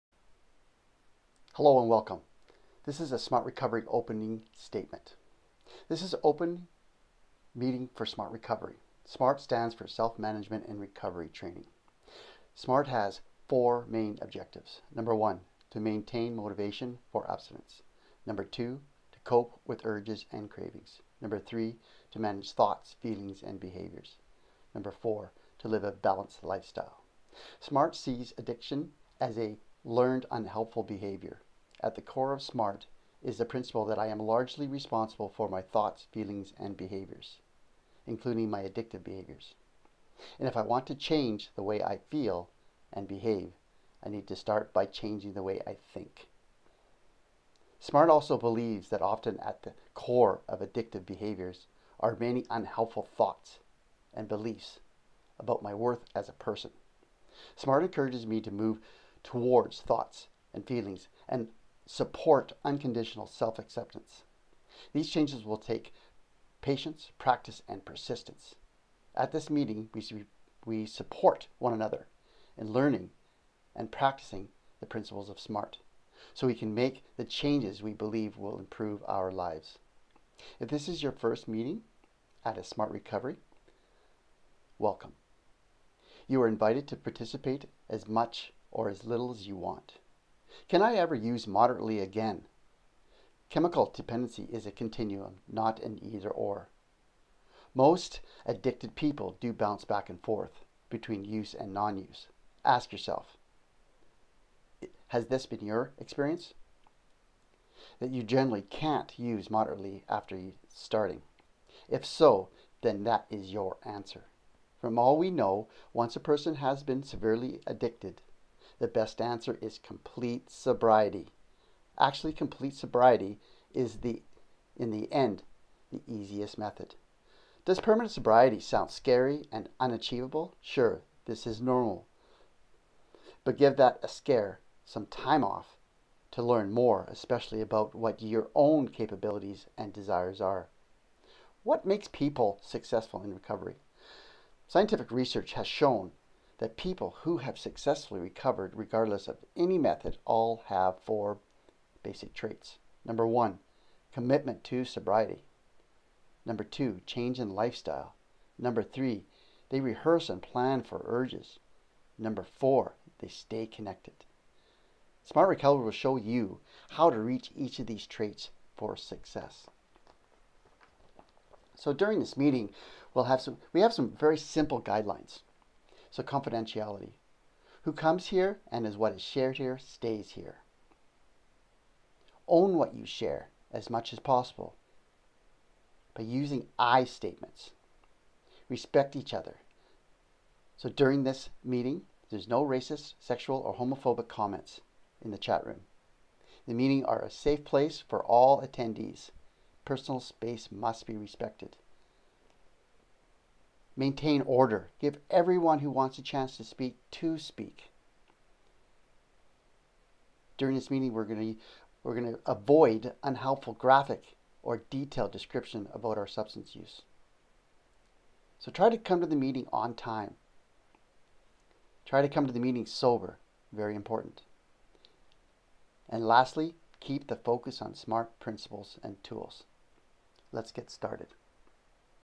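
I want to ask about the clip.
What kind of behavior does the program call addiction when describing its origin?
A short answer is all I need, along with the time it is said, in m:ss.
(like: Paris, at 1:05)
learned unhelpful behavior, at 0:29.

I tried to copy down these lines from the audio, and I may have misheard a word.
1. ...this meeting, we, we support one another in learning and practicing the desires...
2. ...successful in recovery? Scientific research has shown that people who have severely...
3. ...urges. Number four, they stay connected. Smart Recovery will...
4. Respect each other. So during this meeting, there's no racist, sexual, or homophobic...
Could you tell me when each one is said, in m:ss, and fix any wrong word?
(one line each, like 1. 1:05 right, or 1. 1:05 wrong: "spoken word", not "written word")
1. 1:09 wrong: "principles", not "desires"
2. 2:22 wrong: "successfully", not "severely"
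3. 2:41 right
4. 3:08 right.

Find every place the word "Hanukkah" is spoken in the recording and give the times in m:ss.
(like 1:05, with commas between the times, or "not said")
not said.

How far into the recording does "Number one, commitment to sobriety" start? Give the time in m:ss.
2:33.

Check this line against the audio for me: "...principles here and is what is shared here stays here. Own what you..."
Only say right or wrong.
wrong.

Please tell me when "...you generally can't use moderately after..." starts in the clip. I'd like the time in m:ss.
1:48.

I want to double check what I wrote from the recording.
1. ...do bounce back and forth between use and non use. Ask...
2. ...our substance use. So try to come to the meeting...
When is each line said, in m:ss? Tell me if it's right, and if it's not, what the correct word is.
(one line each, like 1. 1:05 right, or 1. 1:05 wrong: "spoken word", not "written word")
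1. 1:39 right
2. 3:36 right.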